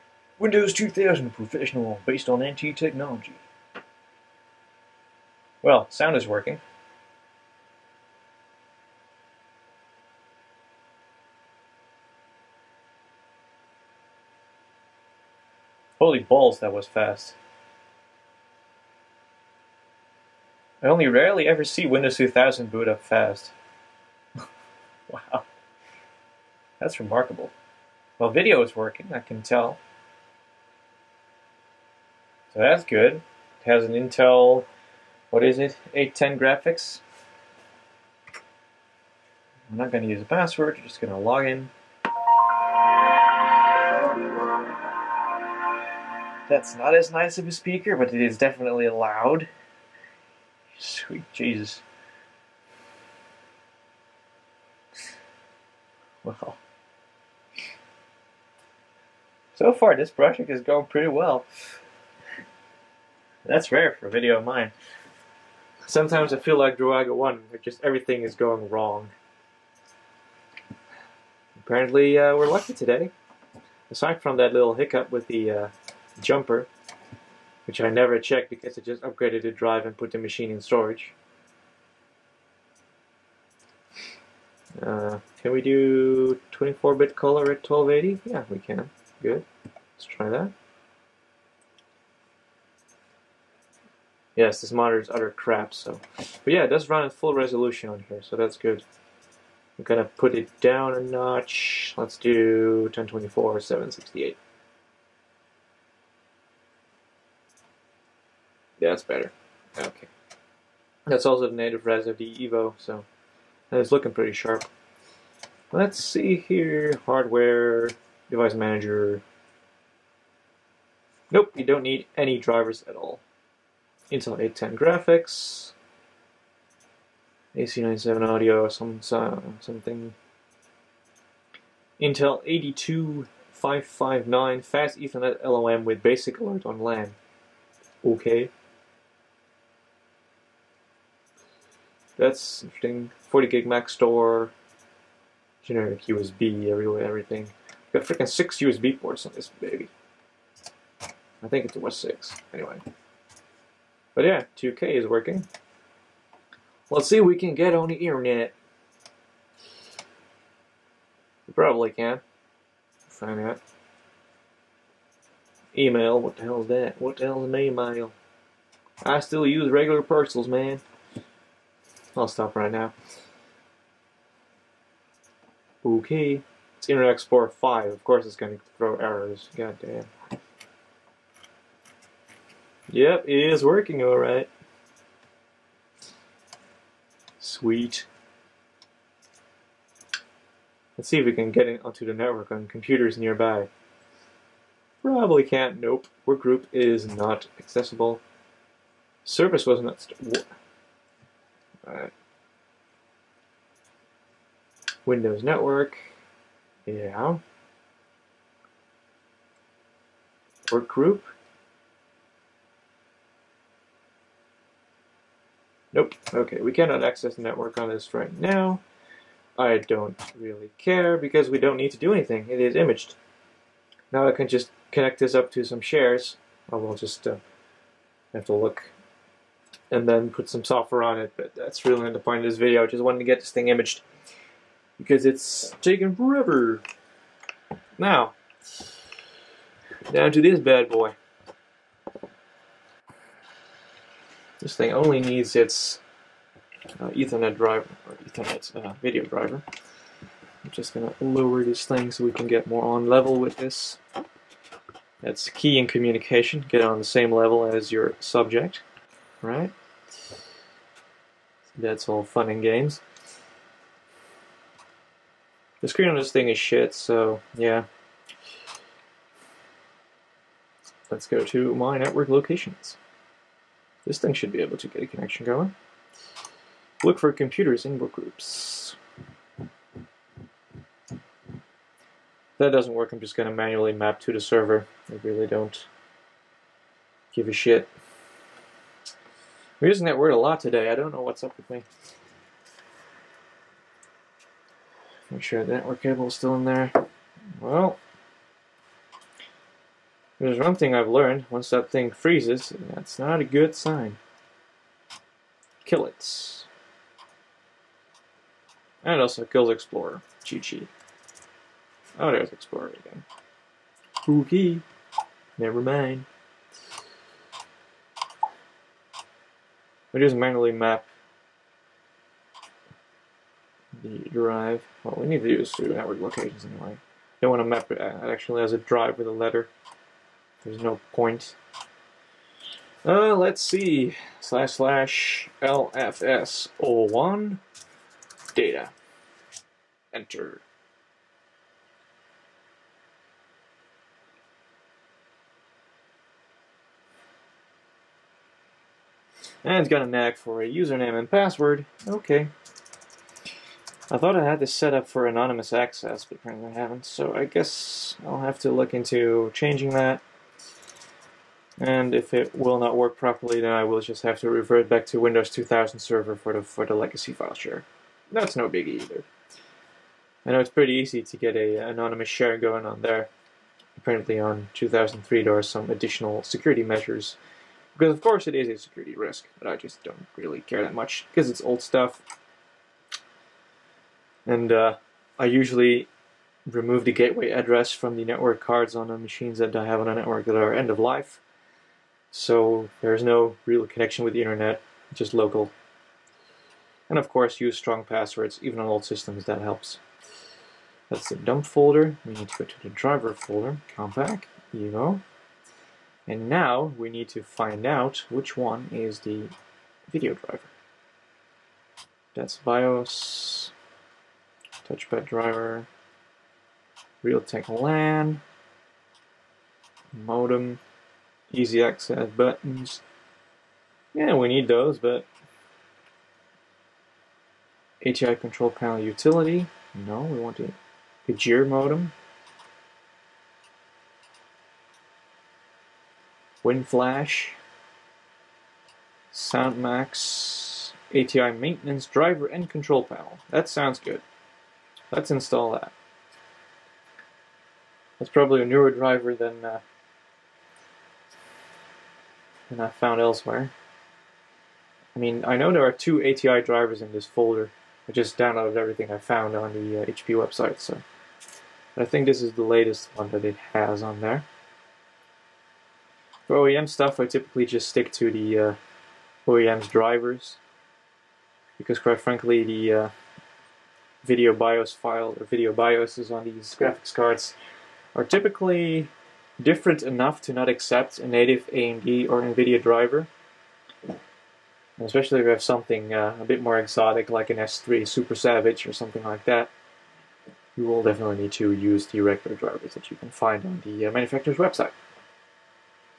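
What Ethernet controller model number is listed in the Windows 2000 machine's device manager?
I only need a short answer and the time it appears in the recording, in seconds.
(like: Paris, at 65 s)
82559, at 132 s.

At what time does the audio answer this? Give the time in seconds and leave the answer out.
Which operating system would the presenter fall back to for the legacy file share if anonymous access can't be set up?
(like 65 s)
365 s.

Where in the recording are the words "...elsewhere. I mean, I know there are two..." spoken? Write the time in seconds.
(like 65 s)
453 s.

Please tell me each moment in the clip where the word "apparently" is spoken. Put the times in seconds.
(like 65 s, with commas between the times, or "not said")
71 s, 356 s, 373 s.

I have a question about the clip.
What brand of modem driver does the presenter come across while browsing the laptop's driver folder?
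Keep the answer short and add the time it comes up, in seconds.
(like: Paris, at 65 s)
Agere, at 431 s.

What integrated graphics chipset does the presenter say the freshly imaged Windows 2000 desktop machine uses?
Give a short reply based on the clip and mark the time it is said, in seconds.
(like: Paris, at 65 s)
Intel 810, at 33 s.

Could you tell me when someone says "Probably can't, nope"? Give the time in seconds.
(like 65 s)
195 s.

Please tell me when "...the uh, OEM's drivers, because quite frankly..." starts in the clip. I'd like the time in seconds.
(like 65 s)
468 s.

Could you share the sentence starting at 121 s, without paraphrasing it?
Nope, you don't need any drivers at all.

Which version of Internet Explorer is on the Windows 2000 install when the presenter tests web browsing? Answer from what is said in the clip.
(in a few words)
5.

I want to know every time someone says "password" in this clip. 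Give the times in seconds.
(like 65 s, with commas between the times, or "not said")
40 s, 351 s, 398 s.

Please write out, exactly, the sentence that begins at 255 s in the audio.
That's key in communication, get on the same level as your subject, right?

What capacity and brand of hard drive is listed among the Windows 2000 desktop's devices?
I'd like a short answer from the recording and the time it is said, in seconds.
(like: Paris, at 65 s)
40 gig Maxtor, at 143 s.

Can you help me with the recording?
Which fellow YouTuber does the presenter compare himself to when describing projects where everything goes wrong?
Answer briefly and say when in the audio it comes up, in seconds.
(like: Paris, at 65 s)
Druaga1, at 66 s.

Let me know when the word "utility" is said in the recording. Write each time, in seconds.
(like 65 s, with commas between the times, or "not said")
428 s.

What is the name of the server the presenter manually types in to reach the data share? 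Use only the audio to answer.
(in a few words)
LFS01.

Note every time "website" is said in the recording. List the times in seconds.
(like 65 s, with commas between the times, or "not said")
460 s, 494 s.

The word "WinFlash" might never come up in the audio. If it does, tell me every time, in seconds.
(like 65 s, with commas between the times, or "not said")
436 s.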